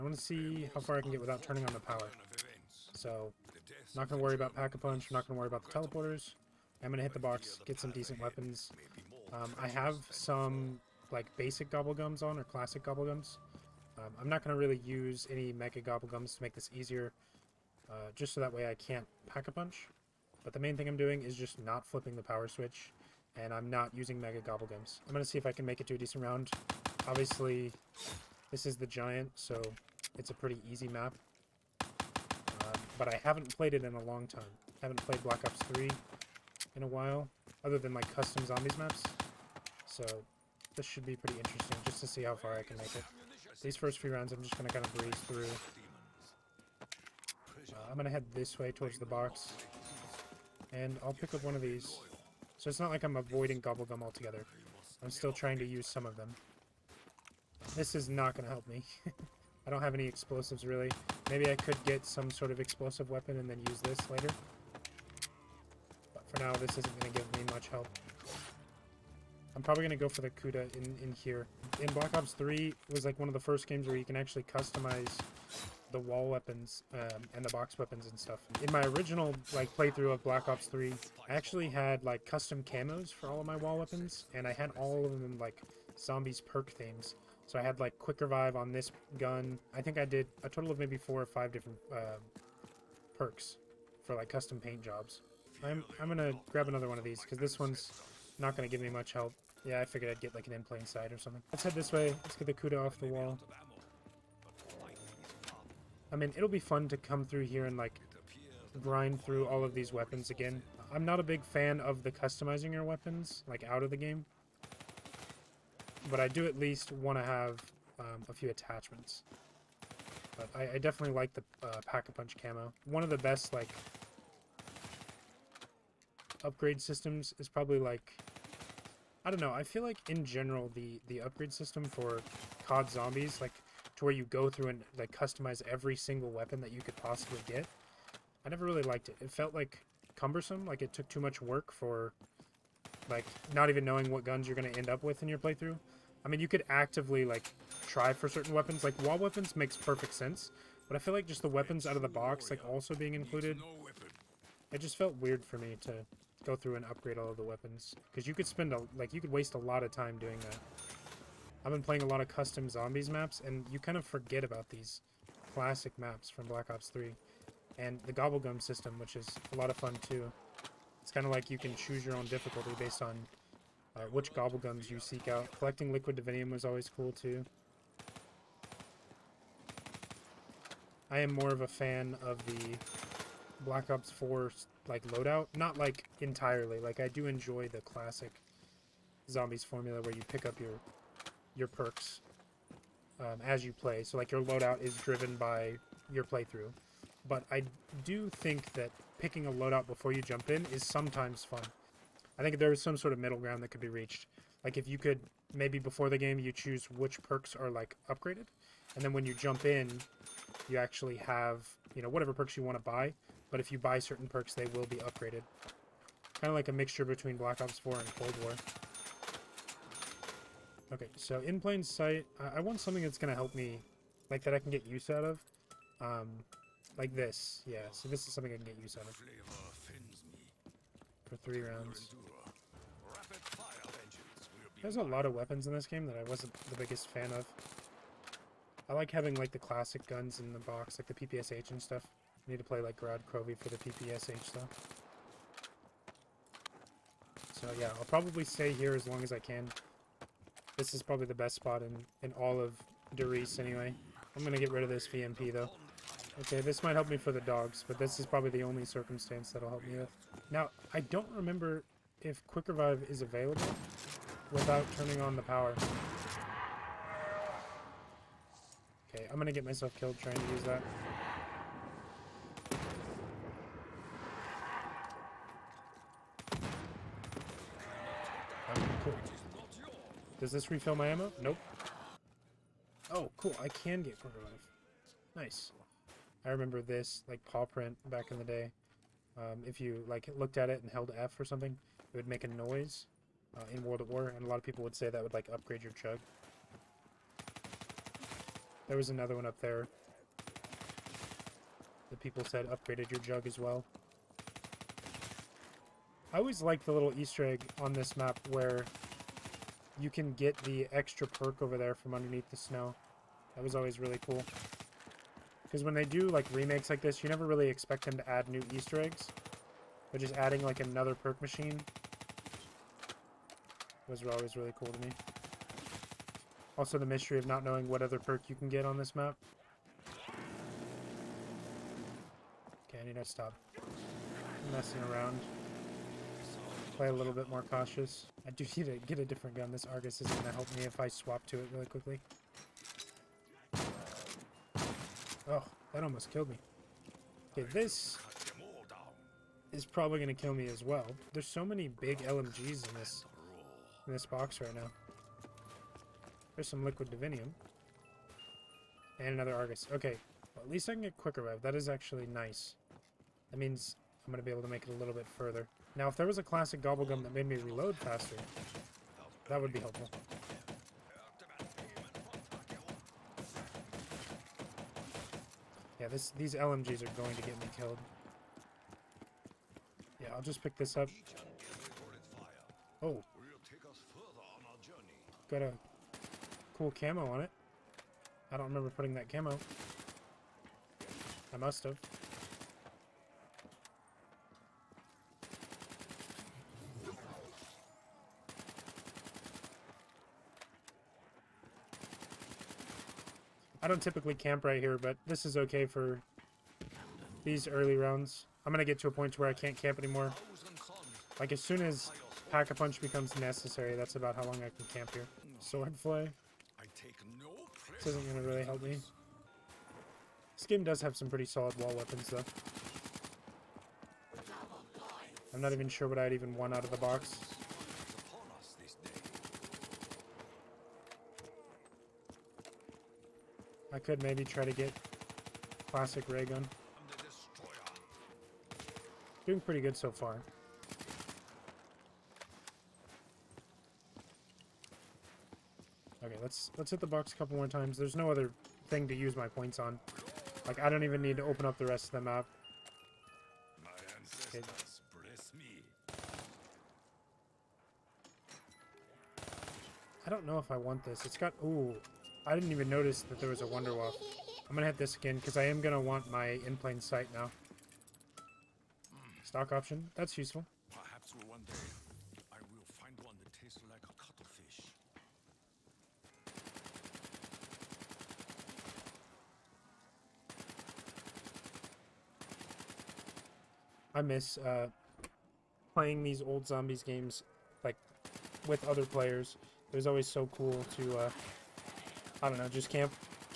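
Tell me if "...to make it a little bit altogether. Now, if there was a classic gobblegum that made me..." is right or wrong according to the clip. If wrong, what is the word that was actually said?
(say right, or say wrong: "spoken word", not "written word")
wrong: "further", not "altogether".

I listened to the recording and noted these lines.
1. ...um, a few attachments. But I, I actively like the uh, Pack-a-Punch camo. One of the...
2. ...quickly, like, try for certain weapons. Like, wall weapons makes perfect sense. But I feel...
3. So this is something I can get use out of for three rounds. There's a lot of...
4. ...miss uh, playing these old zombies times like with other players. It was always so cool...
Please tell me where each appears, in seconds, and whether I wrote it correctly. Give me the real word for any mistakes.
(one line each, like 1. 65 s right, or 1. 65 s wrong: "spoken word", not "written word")
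1. 117 s wrong: "definitely", not "actively"
2. 146 s wrong: "actively", not "quickly"
3. 227 s right
4. 484 s wrong: "games", not "times".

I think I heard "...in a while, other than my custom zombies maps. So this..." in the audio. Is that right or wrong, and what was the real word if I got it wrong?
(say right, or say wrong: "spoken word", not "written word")
right.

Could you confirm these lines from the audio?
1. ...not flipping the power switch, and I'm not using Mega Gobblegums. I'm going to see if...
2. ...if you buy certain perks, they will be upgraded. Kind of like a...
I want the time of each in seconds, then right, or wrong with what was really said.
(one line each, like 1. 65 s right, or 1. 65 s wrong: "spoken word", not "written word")
1. 21 s right
2. 213 s right.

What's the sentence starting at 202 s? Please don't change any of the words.
I think there's some sort of middle ground that could be reached.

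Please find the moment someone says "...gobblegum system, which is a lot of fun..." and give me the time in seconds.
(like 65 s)
168 s.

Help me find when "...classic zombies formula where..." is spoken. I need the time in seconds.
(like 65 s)
187 s.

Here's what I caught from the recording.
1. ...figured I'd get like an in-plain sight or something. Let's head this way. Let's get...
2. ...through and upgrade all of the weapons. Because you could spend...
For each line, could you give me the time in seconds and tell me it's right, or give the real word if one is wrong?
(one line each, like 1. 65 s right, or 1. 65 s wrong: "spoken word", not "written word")
1. 99 s right
2. 156 s right.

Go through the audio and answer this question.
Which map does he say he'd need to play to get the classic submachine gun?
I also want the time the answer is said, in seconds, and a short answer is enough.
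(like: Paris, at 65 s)
Gorod Krovi, at 242 s.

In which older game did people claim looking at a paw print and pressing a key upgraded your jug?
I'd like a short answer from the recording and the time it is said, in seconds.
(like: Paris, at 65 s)
World of War, at 293 s.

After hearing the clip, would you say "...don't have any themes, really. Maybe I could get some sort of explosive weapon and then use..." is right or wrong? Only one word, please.
wrong.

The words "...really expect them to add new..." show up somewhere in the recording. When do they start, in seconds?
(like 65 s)
317 s.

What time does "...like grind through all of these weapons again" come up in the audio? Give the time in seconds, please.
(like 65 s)
107 s.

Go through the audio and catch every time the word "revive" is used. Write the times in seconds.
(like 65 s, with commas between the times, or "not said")
88 s, 262 s, 284 s, 361 s.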